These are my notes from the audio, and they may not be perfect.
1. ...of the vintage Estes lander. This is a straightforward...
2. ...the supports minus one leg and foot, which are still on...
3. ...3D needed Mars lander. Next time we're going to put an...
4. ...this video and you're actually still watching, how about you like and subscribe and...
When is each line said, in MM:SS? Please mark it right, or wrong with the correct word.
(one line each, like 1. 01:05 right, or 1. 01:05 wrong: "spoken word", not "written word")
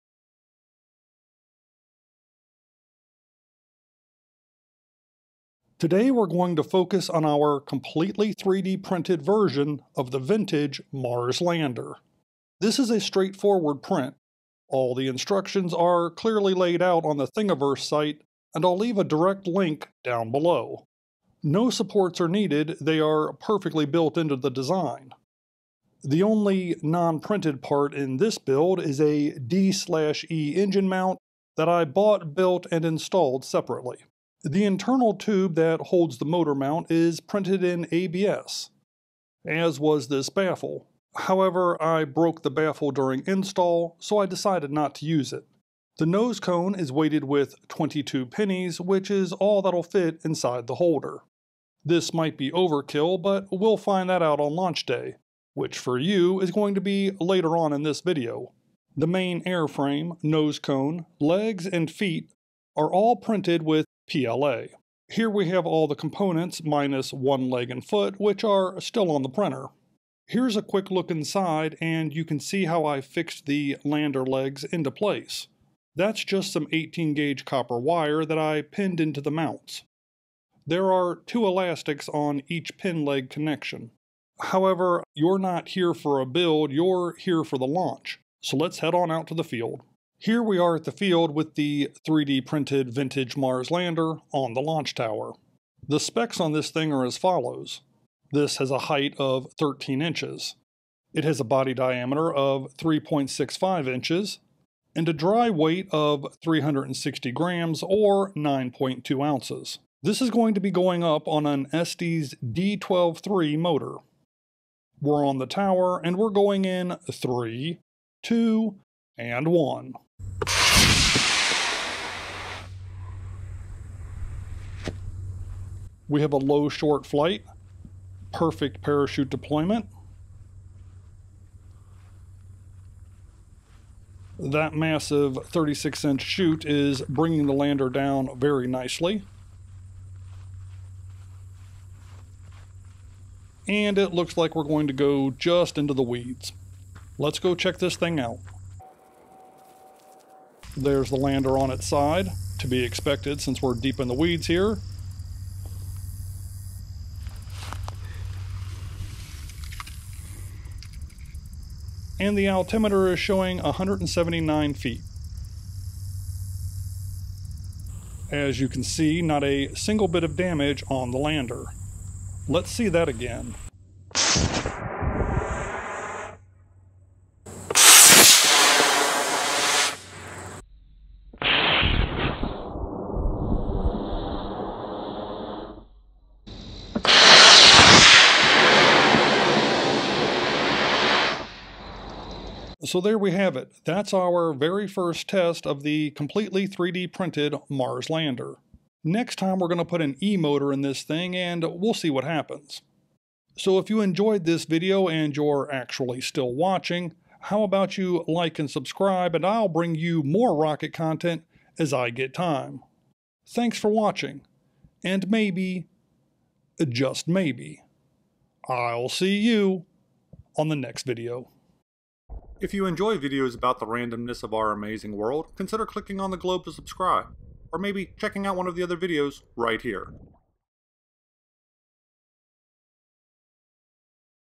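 1. 00:09 wrong: "Mars", not "Estes"
2. 01:05 wrong: "components", not "supports"
3. 03:16 wrong: "printed", not "needed"
4. 03:24 right.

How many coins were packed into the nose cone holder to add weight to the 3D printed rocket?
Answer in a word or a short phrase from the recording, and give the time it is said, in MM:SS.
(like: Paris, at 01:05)
22, at 00:47.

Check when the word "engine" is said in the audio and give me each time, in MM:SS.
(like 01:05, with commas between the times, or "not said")
00:30.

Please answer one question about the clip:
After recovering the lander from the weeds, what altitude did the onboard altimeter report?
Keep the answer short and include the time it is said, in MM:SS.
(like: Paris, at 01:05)
179 feet, at 02:43.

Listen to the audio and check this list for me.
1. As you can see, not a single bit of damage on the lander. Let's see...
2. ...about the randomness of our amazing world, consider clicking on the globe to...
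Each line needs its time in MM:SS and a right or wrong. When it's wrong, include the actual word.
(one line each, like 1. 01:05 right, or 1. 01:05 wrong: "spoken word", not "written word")
1. 02:48 right
2. 03:43 right.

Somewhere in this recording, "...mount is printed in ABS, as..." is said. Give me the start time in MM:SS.
00:36.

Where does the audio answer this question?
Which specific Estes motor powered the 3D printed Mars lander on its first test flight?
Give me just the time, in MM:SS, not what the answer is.
01:51.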